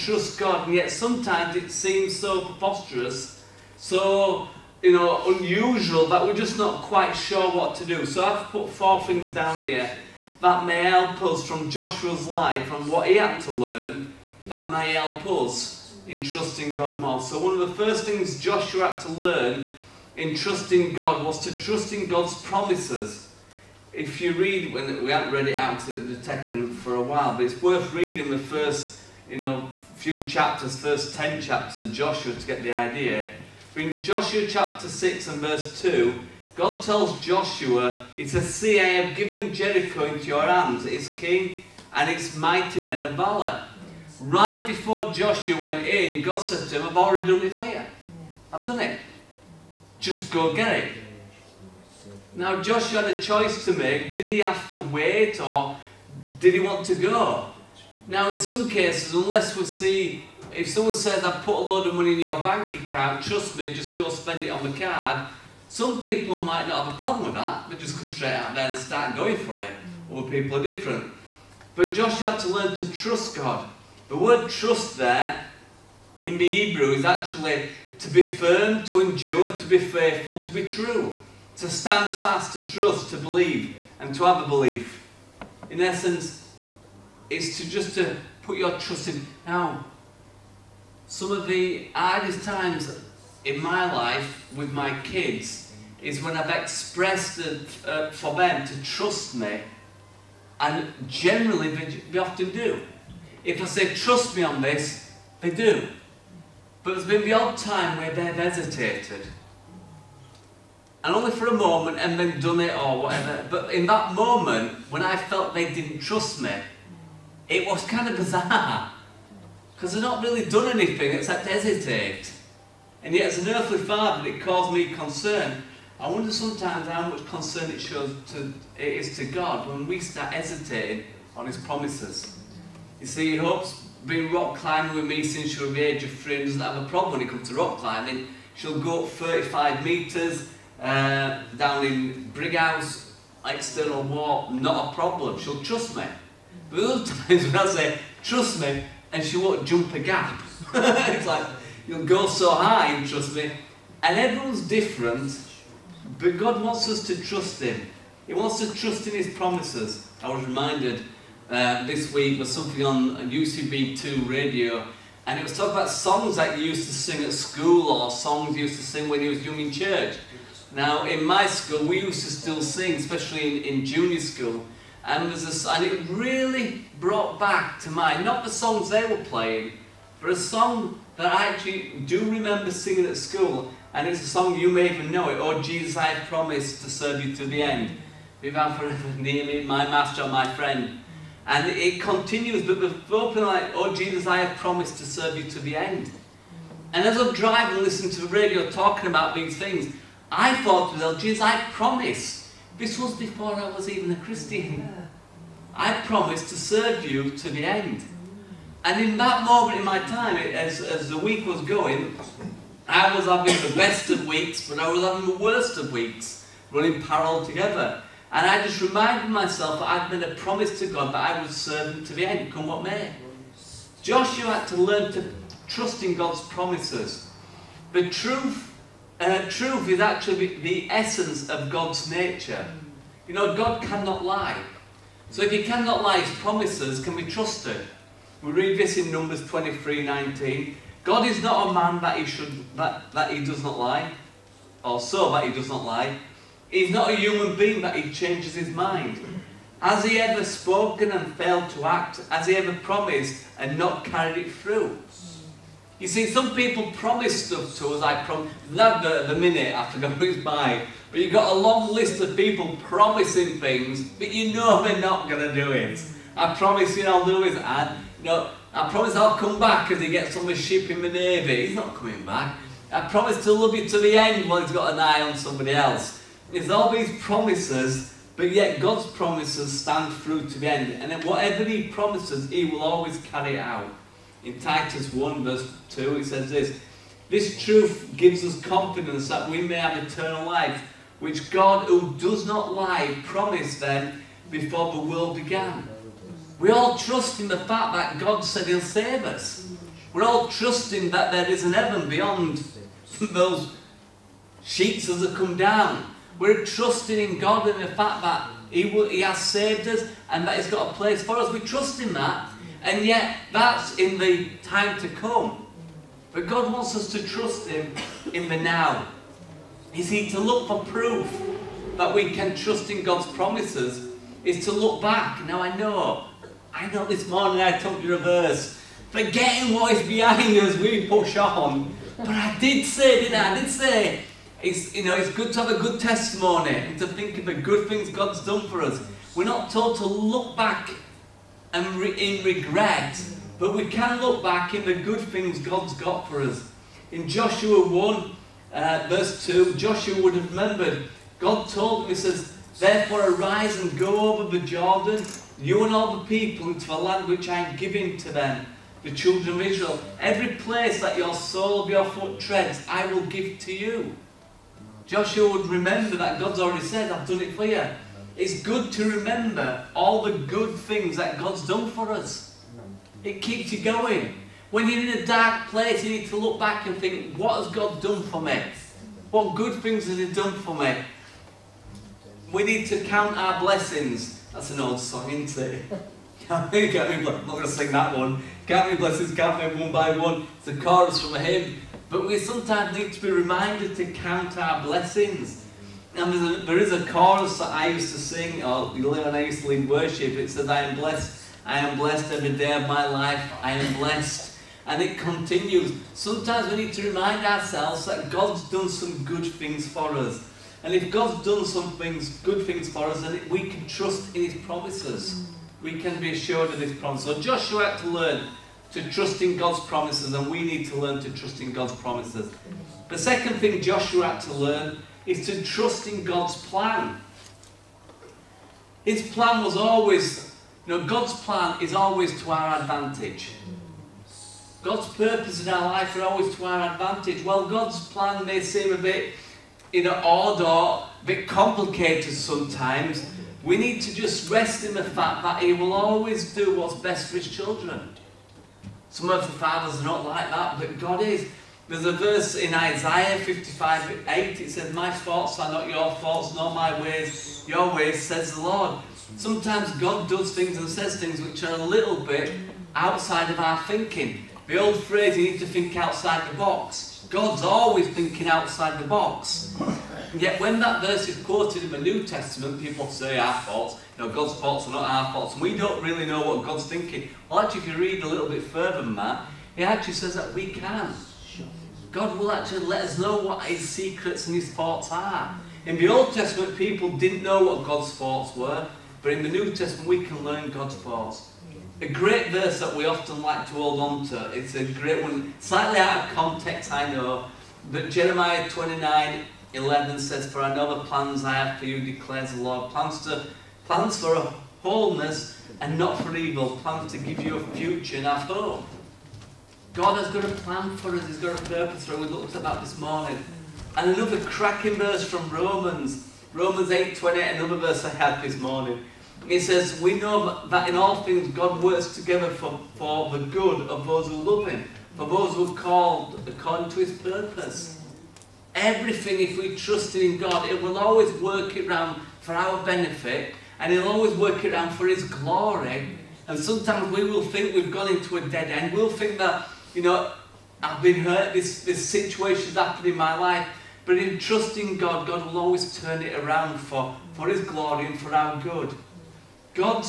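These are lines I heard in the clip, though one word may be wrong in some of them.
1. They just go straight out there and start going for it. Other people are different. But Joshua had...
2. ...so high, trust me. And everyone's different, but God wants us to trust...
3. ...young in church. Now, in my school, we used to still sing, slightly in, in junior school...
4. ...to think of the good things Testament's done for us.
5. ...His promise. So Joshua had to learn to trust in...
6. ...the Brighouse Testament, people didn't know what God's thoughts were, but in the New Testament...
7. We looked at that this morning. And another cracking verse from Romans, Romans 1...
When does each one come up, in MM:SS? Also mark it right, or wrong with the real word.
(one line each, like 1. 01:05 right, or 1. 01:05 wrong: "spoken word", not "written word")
1. 01:07 right
2. 02:32 right
3. 02:49 wrong: "especially", not "slightly"
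4. 05:36 wrong: "God", not "Testament"
5. 06:56 right
6. 08:05 wrong: "Old", not "Brighouse"
7. 08:32 wrong: "8", not "1".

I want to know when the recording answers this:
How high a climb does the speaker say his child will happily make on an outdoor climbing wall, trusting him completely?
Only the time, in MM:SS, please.
02:19.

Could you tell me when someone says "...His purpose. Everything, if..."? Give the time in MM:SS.
08:46.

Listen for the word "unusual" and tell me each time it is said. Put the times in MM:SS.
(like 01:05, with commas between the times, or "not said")
00:05.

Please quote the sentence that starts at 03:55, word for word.
So if he cannot lie, his promises can be trusted.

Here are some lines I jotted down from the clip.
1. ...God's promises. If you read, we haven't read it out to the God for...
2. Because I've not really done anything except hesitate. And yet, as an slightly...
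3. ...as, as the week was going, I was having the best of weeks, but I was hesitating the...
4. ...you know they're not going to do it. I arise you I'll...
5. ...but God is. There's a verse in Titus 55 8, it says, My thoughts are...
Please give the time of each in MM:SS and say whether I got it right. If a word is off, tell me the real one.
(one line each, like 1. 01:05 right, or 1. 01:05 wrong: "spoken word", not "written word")
1. 00:22 wrong: "Tekken", not "God"
2. 01:59 wrong: "earthly", not "slightly"
3. 03:30 wrong: "having", not "hesitating"
4. 04:24 wrong: "promise", not "arise"
5. 07:30 wrong: "Isaiah", not "Titus".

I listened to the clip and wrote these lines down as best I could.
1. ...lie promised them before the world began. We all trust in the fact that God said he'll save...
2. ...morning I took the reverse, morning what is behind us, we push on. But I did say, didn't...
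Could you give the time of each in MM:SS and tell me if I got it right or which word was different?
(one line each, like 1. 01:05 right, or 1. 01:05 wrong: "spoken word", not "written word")
1. 04:52 right
2. 05:27 wrong: "forgetting", not "morning".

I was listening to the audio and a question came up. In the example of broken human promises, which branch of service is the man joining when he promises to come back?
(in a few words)
the Navy.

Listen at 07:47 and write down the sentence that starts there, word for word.
God's always thinking outside the box.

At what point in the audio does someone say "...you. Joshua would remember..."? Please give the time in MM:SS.
06:03.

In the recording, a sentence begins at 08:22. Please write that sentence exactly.
Plans, to, plans for wholeness and not for evil, plans to give you a future and a hope.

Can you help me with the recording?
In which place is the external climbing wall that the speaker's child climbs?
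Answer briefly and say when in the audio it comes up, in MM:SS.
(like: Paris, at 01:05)
Brighouse, at 02:22.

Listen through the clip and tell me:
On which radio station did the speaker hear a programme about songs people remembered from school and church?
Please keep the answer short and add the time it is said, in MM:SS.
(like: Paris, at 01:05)
UCB2, at 02:43.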